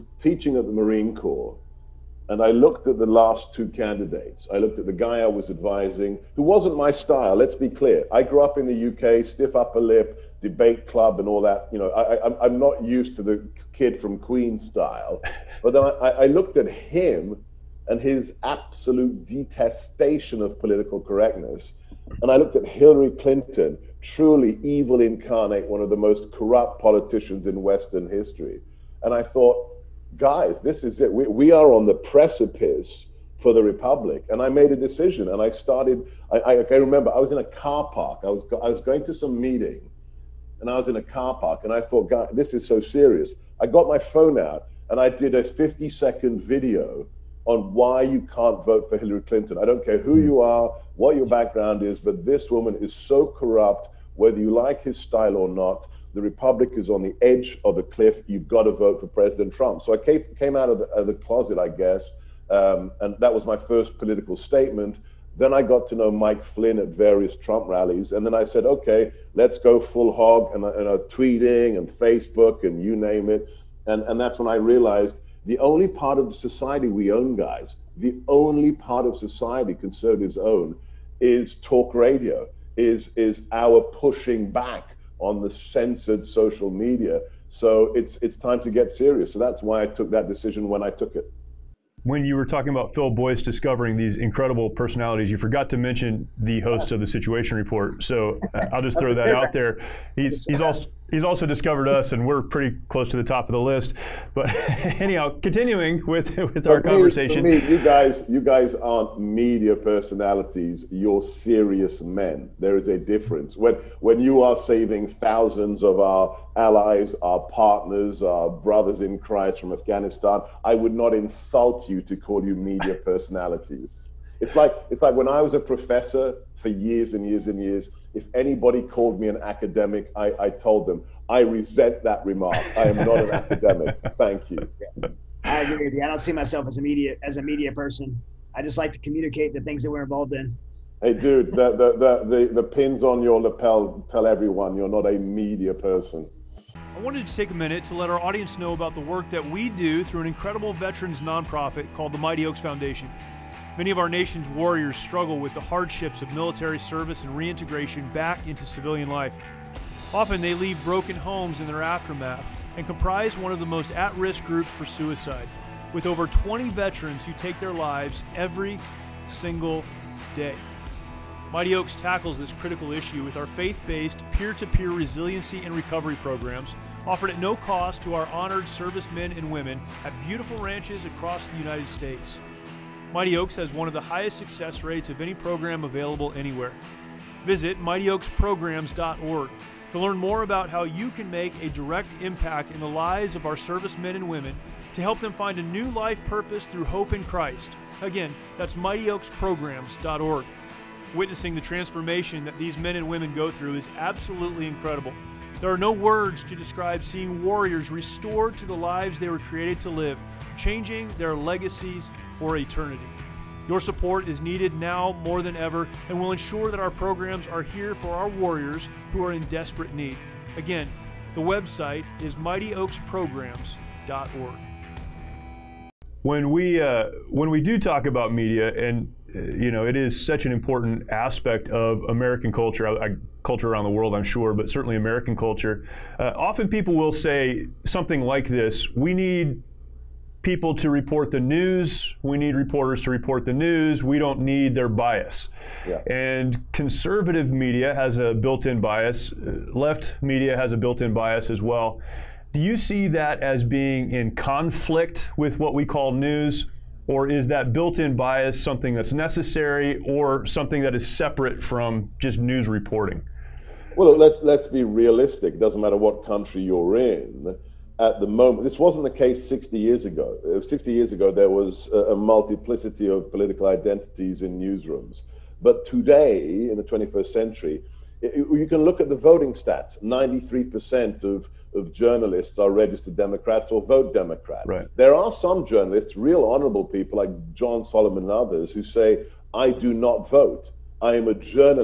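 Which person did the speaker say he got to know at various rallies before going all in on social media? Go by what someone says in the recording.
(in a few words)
Mike Flynn.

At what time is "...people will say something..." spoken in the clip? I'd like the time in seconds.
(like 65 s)
236 s.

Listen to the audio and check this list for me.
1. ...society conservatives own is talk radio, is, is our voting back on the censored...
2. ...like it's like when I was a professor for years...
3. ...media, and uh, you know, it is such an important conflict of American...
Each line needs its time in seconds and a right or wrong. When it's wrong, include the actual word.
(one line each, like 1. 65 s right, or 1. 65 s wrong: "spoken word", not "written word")
1. 79 s wrong: "pushing", not "voting"
2. 124 s right
3. 228 s wrong: "aspect", not "conflict".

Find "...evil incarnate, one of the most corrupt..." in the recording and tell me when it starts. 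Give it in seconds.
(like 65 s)
24 s.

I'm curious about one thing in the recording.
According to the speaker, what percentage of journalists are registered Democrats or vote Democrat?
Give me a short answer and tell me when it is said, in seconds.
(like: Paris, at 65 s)
93%, at 280 s.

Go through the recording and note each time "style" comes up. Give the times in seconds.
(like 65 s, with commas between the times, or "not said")
6 s, 14 s, 54 s.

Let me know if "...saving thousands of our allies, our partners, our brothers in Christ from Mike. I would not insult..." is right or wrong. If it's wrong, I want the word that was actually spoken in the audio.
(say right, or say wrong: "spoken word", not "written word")
wrong: "Afghanistan", not "Mike".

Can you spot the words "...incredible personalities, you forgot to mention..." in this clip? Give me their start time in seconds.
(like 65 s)
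94 s.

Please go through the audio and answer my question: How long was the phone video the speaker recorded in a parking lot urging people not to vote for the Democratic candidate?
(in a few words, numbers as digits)
50 seconds.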